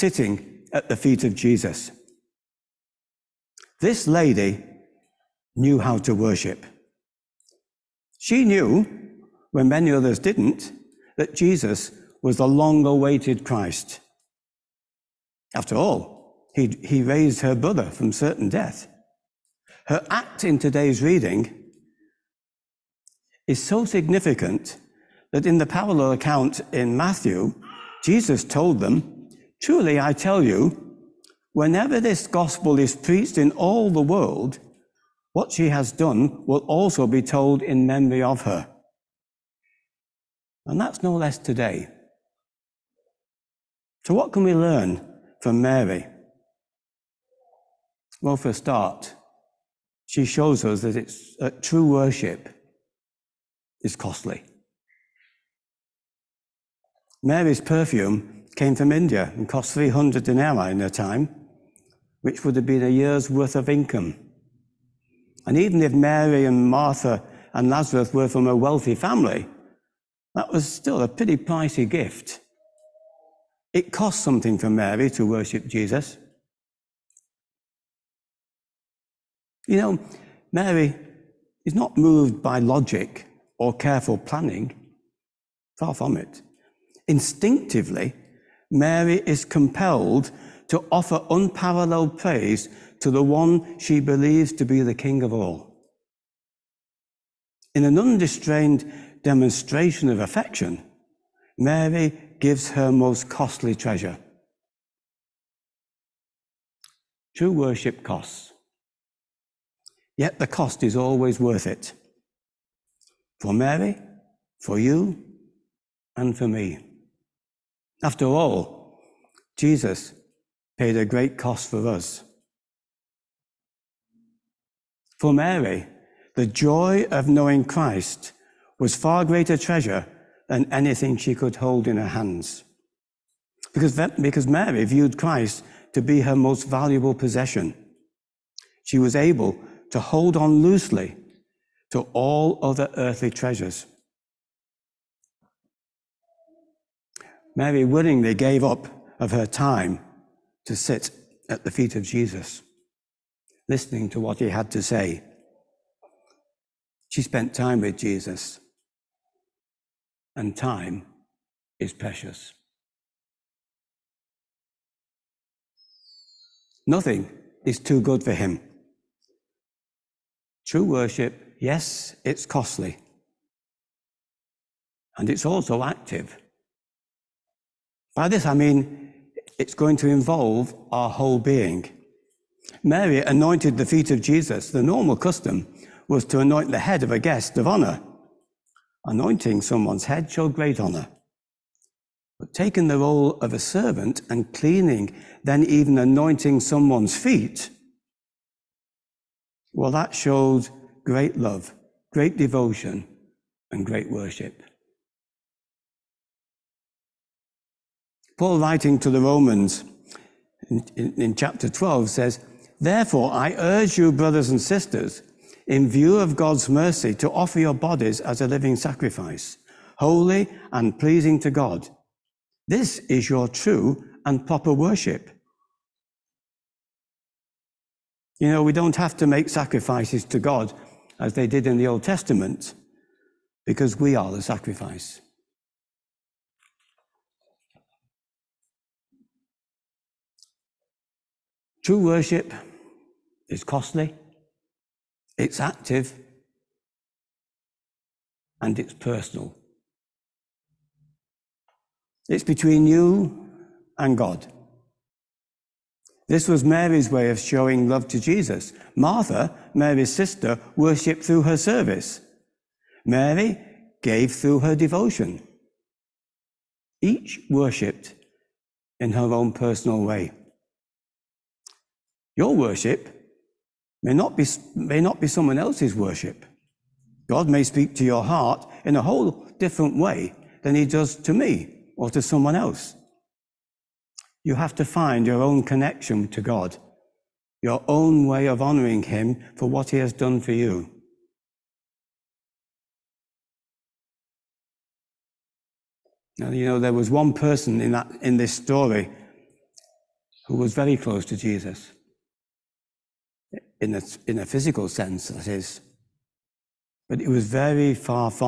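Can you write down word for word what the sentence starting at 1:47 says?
True worship costs, yet the cost is always worth it.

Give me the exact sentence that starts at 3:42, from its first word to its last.
This is your true and proper worship.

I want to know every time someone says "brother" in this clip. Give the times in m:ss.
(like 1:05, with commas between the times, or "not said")
0:17, 3:34.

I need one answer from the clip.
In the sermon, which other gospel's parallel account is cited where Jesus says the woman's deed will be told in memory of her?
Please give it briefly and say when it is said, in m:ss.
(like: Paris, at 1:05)
Matthew, at 0:26.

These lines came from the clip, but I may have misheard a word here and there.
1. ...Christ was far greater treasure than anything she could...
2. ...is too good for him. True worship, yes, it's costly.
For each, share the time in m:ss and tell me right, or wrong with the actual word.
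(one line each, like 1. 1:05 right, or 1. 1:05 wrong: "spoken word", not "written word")
1. 2:07 right
2. 2:47 right.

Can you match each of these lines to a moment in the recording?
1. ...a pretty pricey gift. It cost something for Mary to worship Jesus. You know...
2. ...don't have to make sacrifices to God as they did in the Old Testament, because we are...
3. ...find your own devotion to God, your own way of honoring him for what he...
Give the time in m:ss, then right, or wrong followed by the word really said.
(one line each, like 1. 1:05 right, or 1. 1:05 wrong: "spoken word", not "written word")
1. 1:11 right
2. 3:48 right
3. 4:44 wrong: "connection", not "devotion".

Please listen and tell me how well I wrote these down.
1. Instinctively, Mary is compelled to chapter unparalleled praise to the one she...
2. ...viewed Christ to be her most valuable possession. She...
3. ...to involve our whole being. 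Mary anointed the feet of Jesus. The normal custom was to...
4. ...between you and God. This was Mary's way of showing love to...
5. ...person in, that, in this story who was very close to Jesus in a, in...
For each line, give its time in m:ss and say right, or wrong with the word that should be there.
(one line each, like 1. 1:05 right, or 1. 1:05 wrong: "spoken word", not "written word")
1. 1:27 wrong: "offer", not "chapter"
2. 2:14 right
3. 2:59 right
4. 4:12 right
5. 4:57 right.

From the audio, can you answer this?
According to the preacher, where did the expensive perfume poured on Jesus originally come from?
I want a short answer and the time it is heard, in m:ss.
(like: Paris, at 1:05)
India, at 0:58.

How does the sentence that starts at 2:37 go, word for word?
She spent time with Jesus, and time is precious.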